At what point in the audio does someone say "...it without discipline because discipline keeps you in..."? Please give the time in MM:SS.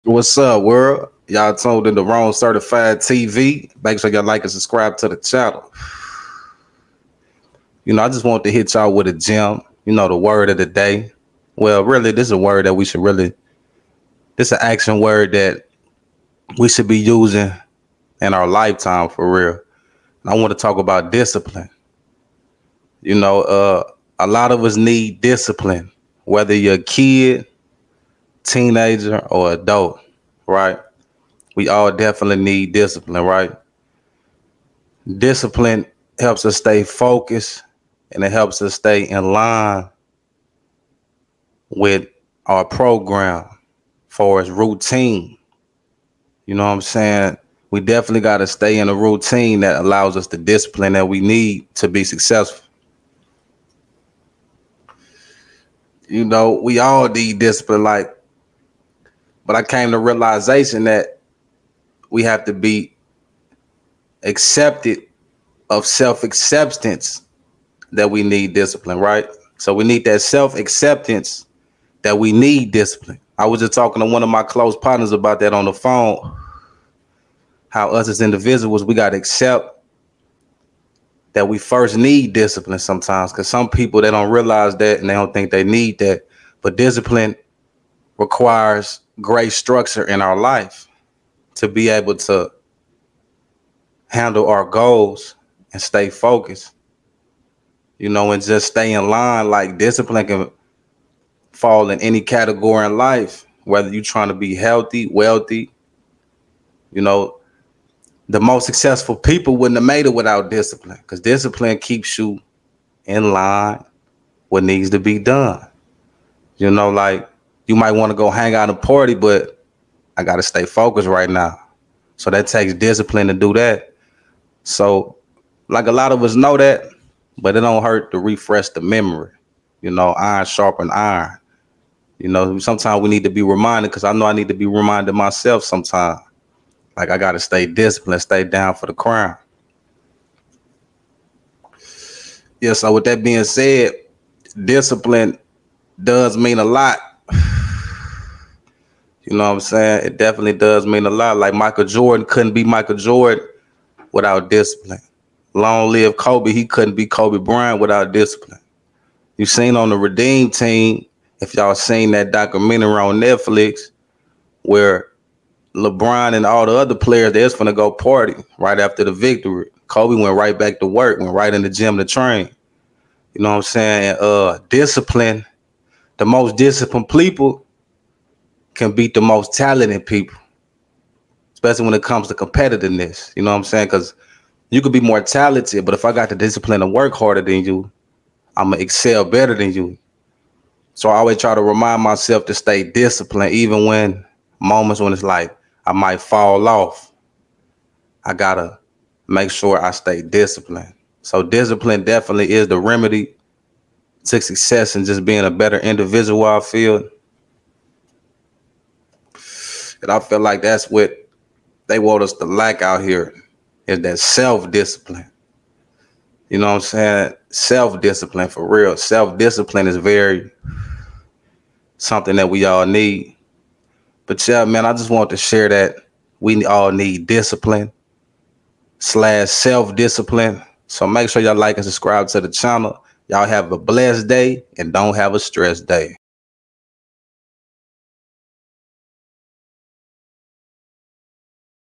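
01:50.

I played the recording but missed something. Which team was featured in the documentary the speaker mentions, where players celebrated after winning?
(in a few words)
Redeem Team.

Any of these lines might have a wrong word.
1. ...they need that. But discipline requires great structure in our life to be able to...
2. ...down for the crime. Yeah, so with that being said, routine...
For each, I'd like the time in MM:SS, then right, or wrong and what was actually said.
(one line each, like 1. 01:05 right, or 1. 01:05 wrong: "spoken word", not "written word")
1. 01:25 right
2. 02:18 wrong: "discipline", not "routine".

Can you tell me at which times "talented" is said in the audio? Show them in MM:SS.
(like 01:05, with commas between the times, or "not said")
02:59, 03:05.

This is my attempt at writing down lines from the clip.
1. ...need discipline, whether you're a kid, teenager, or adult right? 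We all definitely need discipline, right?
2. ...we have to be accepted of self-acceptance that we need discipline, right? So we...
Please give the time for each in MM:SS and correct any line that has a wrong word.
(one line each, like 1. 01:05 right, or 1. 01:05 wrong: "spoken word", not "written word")
1. 00:24 right
2. 01:02 right.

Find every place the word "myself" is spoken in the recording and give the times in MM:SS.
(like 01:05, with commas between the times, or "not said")
02:15, 03:12.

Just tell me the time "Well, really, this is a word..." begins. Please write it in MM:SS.
00:11.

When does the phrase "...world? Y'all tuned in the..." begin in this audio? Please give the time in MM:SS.
00:00.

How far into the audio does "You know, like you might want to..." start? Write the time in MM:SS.
01:56.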